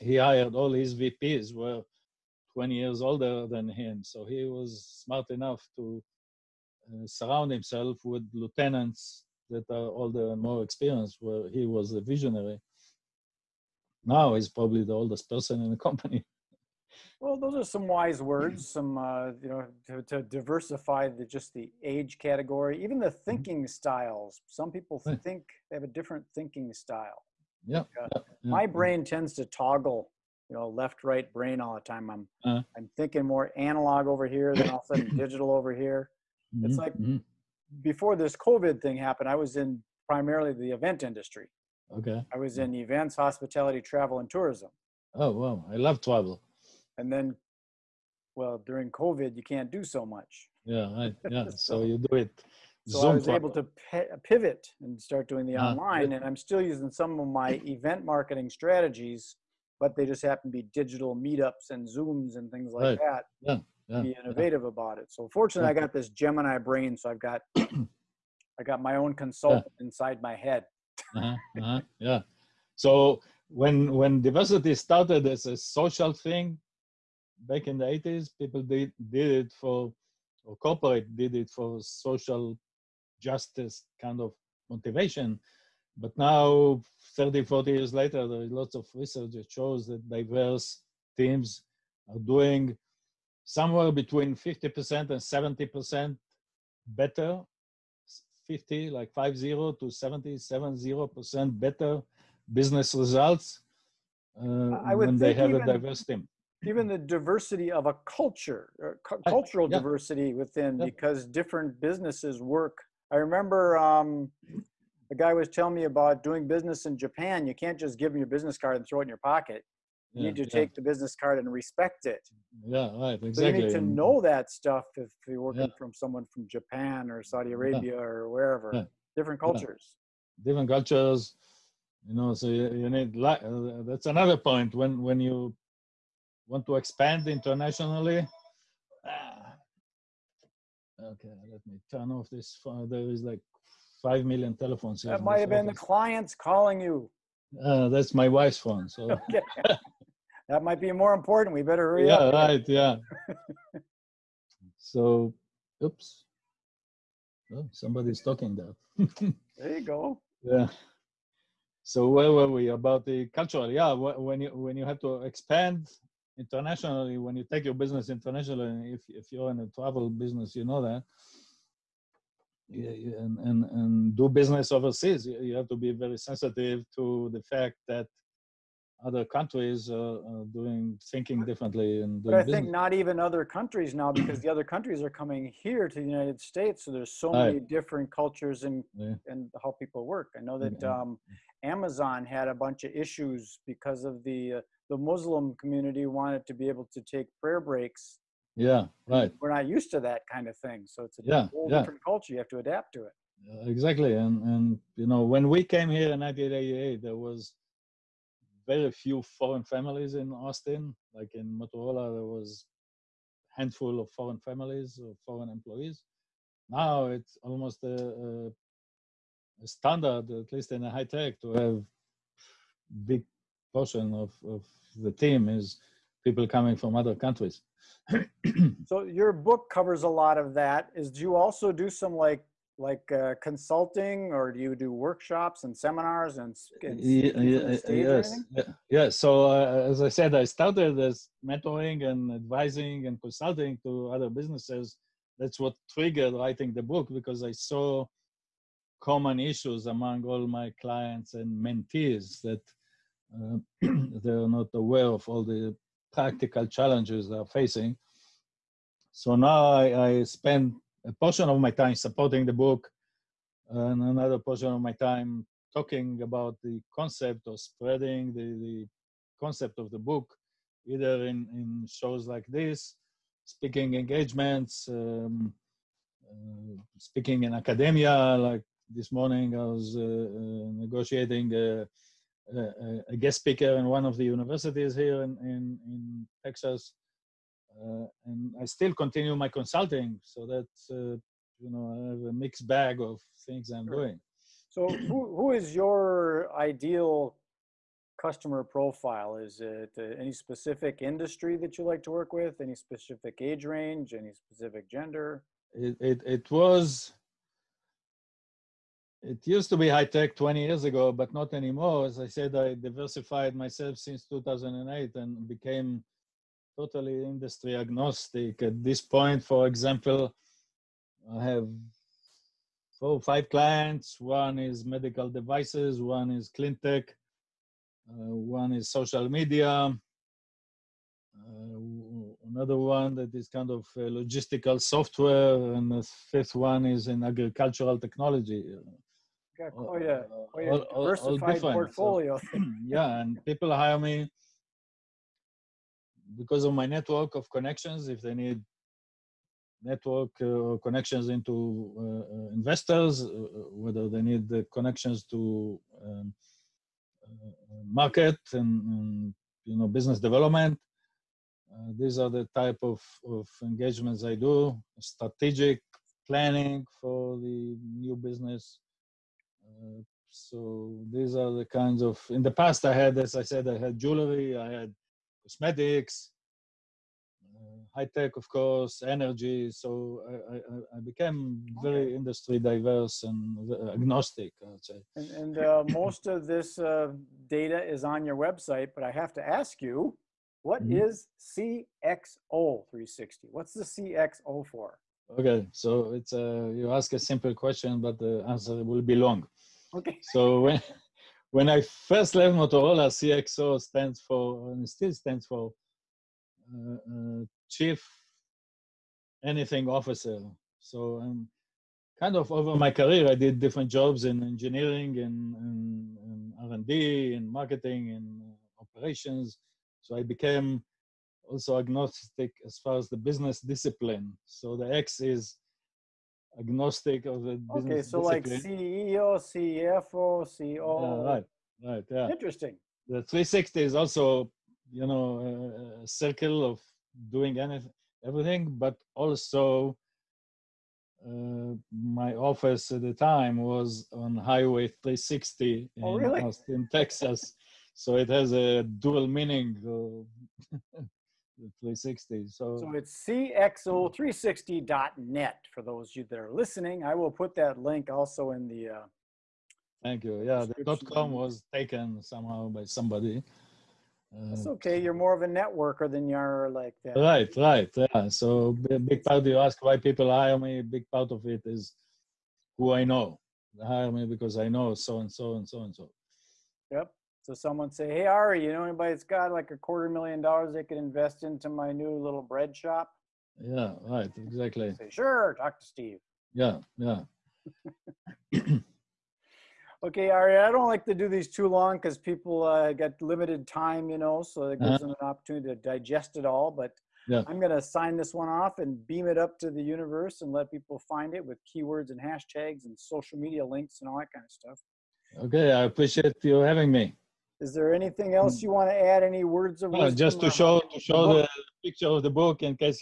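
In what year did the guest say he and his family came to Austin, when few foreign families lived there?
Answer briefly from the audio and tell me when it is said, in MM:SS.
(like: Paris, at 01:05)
1988, at 03:26.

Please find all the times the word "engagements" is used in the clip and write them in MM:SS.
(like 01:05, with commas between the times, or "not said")
04:33, 06:03.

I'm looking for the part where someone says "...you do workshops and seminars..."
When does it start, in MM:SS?
03:54.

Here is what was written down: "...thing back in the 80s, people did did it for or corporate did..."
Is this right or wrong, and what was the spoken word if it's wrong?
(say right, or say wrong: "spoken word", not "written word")
right.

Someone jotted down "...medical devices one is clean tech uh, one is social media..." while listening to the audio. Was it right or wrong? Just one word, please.
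right.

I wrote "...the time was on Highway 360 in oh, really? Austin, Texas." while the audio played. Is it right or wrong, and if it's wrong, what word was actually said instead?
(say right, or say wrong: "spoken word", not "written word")
right.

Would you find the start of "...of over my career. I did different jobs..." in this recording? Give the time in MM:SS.
06:52.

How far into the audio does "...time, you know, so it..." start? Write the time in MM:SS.
08:13.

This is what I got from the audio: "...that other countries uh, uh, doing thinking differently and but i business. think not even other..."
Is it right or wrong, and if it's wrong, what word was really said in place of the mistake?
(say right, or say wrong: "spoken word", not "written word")
right.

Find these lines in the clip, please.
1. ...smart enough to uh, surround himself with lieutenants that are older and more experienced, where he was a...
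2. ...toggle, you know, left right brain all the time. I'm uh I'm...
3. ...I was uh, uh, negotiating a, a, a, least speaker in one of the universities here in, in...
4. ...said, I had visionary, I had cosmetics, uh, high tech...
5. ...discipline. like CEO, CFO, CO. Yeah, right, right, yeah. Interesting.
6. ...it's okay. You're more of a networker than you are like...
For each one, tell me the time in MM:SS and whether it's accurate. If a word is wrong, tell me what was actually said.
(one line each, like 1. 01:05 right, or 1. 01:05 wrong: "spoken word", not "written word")
1. 00:05 right
2. 00:29 right
3. 04:39 wrong: "guest", not "least"
4. 06:13 wrong: "jewelry", not "visionary"
5. 07:08 right
6. 07:44 right.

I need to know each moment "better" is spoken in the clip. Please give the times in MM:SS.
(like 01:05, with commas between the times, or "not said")
01:36, 01:41, 02:31.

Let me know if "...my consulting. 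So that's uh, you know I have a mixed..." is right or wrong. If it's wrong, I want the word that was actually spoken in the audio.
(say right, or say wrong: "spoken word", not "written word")
right.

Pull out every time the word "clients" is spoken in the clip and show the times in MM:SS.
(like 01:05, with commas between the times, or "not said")
02:25, 04:10, 05:23.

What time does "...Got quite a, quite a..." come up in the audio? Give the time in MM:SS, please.
05:39.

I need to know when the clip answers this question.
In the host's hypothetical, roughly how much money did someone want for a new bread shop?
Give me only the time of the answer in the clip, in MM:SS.
07:59.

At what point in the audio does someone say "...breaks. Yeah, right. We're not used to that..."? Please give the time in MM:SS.
03:17.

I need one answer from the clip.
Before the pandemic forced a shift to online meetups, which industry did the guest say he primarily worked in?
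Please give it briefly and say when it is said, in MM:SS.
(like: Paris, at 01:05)
event industry, at 00:40.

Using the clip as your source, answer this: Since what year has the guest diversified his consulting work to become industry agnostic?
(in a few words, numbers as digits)
2008.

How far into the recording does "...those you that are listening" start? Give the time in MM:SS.
07:35.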